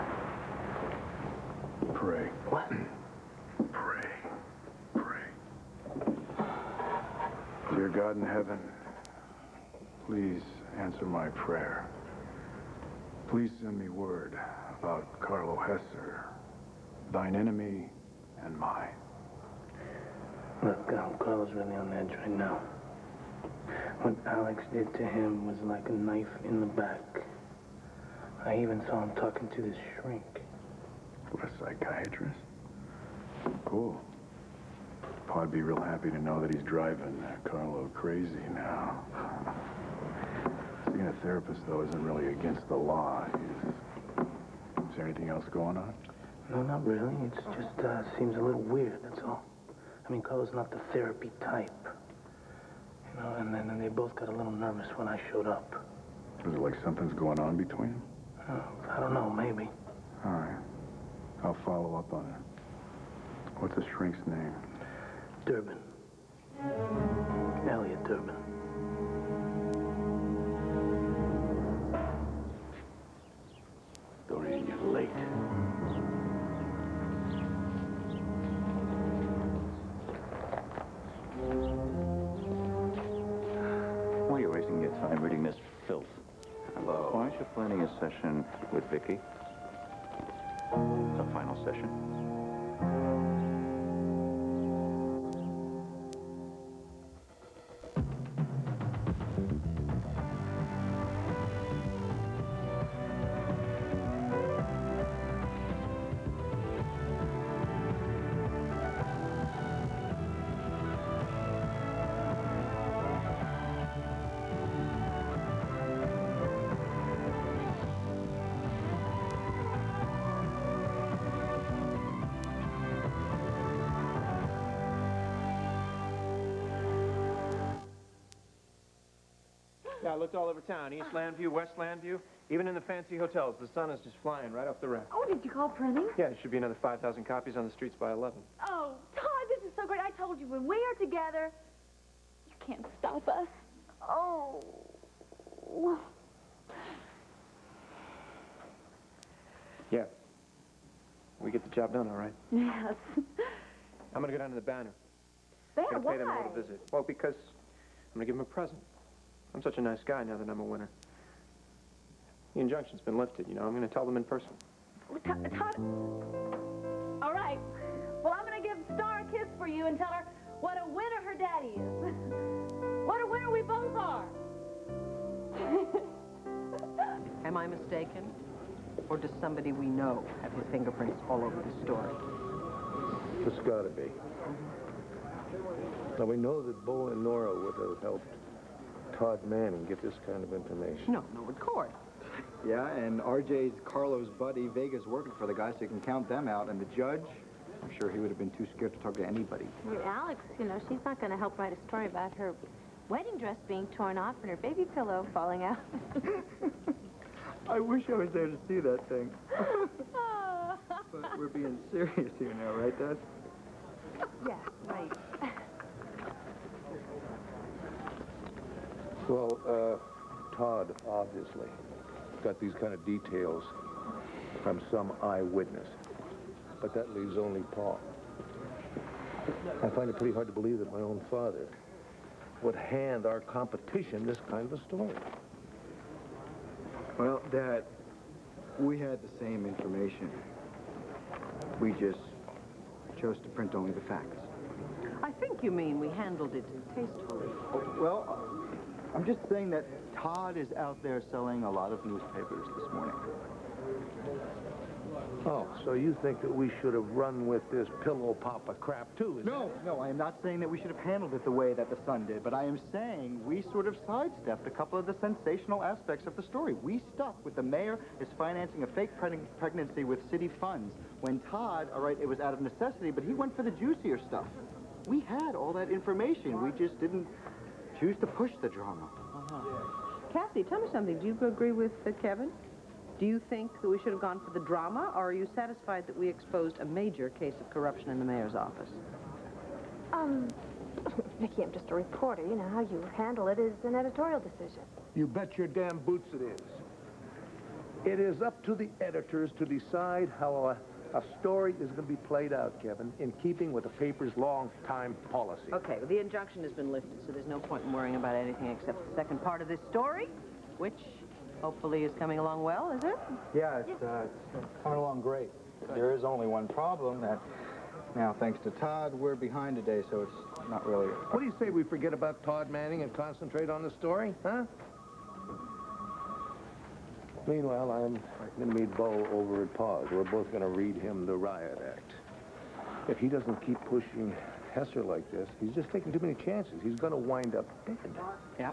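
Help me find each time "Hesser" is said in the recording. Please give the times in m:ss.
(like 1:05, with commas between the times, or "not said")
0:15, 5:34.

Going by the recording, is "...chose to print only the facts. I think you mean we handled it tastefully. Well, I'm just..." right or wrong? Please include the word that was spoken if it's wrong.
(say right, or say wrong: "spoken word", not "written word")
right.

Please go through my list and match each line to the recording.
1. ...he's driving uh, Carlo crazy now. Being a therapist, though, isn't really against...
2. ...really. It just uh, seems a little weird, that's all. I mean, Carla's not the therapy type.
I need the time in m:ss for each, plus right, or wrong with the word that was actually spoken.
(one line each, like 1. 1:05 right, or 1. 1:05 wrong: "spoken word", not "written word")
1. 0:36 right
2. 0:46 right.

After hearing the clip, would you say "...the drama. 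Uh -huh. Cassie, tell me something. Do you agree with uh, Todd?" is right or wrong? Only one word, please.
wrong.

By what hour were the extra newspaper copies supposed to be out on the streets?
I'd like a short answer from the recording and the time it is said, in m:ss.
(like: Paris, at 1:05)
11, at 2:18.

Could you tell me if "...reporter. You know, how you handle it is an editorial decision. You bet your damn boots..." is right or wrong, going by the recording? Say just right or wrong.
right.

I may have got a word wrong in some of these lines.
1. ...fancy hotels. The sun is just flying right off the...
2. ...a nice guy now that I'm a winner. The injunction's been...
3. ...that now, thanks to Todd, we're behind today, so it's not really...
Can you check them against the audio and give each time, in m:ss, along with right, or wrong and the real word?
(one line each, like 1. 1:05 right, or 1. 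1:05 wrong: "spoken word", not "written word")
1. 2:12 right
2. 2:39 right
3. 5:17 right.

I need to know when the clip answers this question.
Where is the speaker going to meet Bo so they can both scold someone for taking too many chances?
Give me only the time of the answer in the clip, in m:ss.
5:29.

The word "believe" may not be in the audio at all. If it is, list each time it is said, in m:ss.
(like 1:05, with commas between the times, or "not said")
3:50.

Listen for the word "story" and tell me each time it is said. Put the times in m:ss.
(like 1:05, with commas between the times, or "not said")
3:01, 3:21, 3:54, 4:26, 5:01, 5:09, 5:23.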